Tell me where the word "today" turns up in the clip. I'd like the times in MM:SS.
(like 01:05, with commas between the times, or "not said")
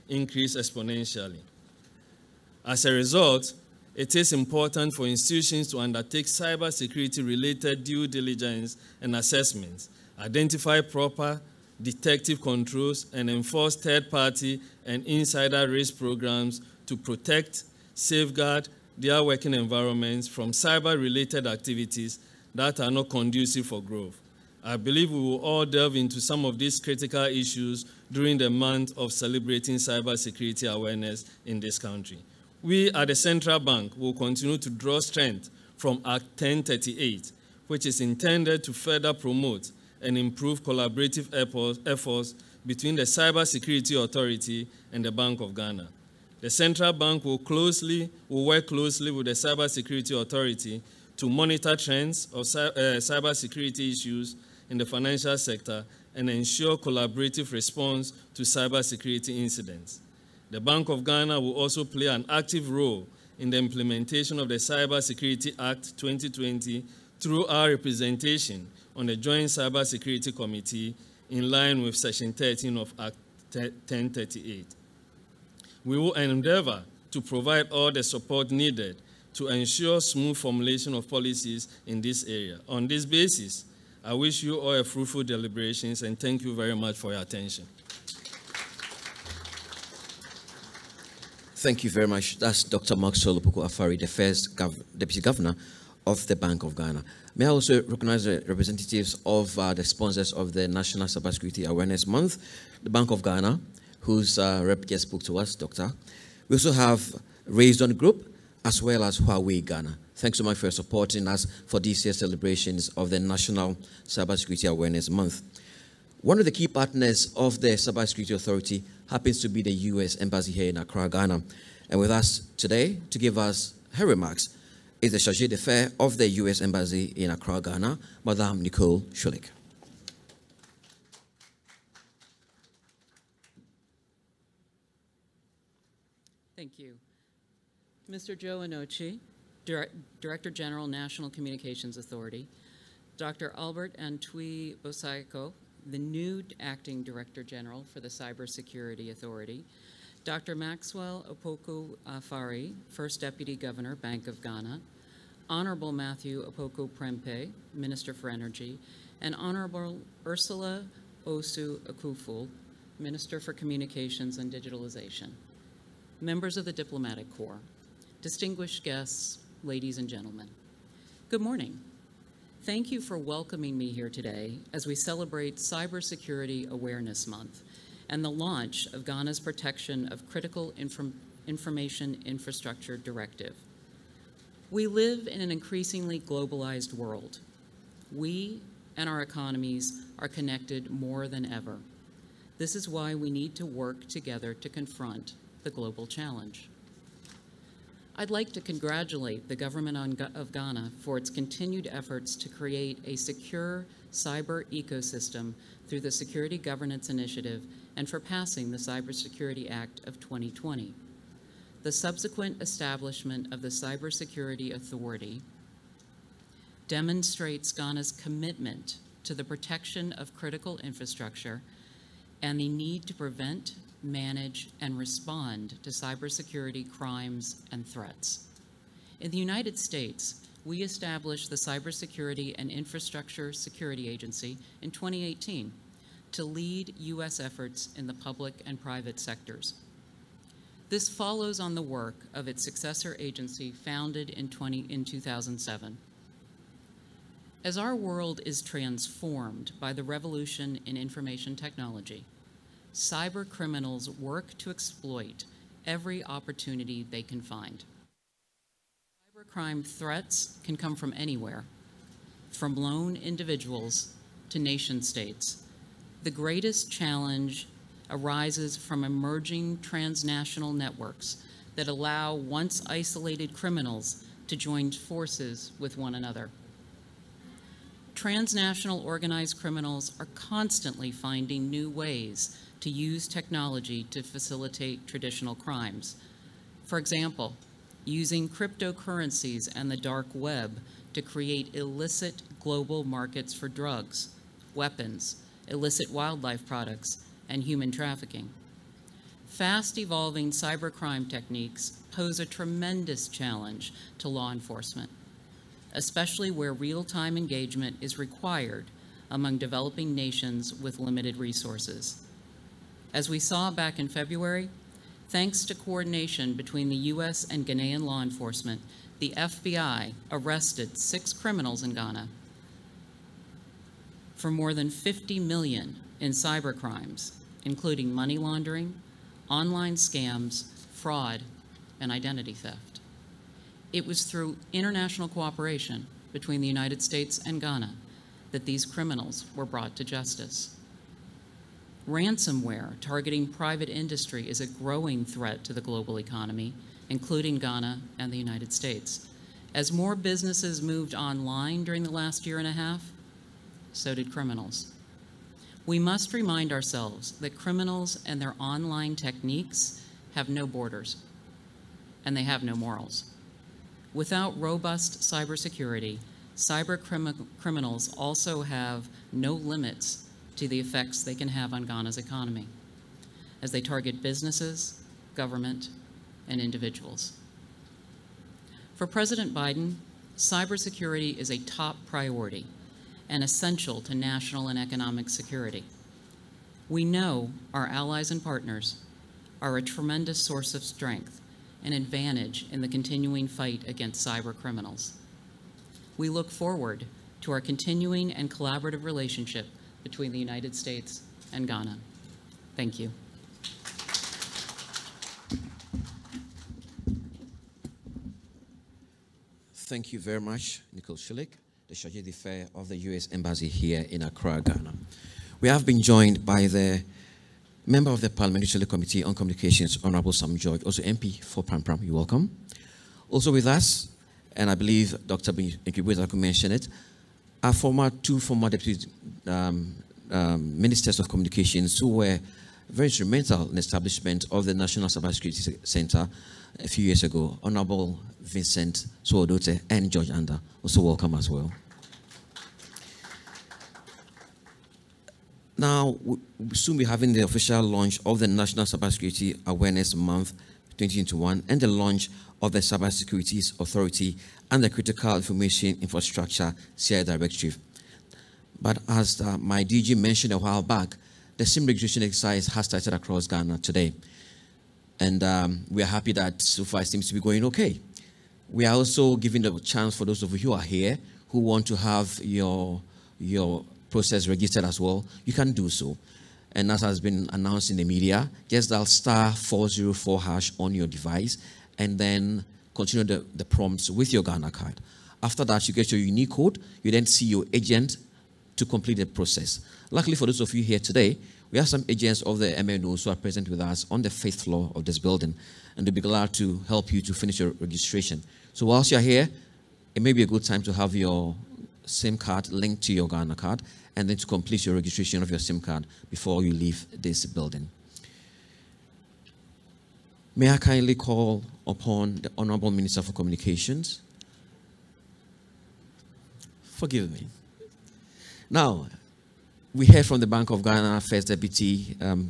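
02:02, 02:54, 07:43, 08:10.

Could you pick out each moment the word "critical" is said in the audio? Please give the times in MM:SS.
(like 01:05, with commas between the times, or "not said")
00:26, 03:00, 03:40, 07:34.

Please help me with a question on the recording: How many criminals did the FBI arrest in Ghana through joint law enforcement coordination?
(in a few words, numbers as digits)
6.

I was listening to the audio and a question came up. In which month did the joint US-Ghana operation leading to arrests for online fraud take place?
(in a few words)
February.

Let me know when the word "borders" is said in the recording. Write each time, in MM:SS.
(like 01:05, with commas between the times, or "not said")
06:00.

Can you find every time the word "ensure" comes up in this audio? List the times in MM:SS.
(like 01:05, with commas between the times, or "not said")
00:56, 01:19.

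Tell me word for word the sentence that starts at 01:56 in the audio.
One of the key partners of the Cybersecurity Authority happens to be the U.S.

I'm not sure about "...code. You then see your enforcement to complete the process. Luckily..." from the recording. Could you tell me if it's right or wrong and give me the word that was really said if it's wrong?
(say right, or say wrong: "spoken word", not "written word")
wrong: "agent", not "enforcement".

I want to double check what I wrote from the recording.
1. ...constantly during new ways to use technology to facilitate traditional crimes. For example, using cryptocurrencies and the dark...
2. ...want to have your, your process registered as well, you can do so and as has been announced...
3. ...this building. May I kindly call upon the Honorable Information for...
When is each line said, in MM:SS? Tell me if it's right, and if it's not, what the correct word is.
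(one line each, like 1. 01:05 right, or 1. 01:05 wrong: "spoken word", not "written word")
1. 04:40 wrong: "finding", not "during"
2. 07:51 right
3. 08:27 wrong: "Minister", not "Information".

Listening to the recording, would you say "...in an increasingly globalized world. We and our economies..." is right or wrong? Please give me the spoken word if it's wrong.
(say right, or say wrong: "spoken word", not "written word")
right.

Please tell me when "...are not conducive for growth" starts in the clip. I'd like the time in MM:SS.
00:22.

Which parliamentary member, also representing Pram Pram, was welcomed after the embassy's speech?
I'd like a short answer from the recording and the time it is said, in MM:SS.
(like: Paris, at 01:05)
Sam George, at 07:00.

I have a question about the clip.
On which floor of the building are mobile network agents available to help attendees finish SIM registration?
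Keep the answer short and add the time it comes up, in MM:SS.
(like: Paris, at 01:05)
fifth floor, at 08:14.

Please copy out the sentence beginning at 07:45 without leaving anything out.
And um, we are happy that so far it seems to be going okay.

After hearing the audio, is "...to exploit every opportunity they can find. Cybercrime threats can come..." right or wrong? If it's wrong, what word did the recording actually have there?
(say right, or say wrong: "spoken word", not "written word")
right.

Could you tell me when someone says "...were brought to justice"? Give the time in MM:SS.
05:39.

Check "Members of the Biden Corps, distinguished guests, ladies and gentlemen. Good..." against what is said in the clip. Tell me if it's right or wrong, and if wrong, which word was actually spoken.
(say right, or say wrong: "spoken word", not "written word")
wrong: "Diplomatic", not "Biden".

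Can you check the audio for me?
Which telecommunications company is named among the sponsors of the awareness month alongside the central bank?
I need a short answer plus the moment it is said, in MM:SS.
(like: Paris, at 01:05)
Huawei Ghana, at 01:49.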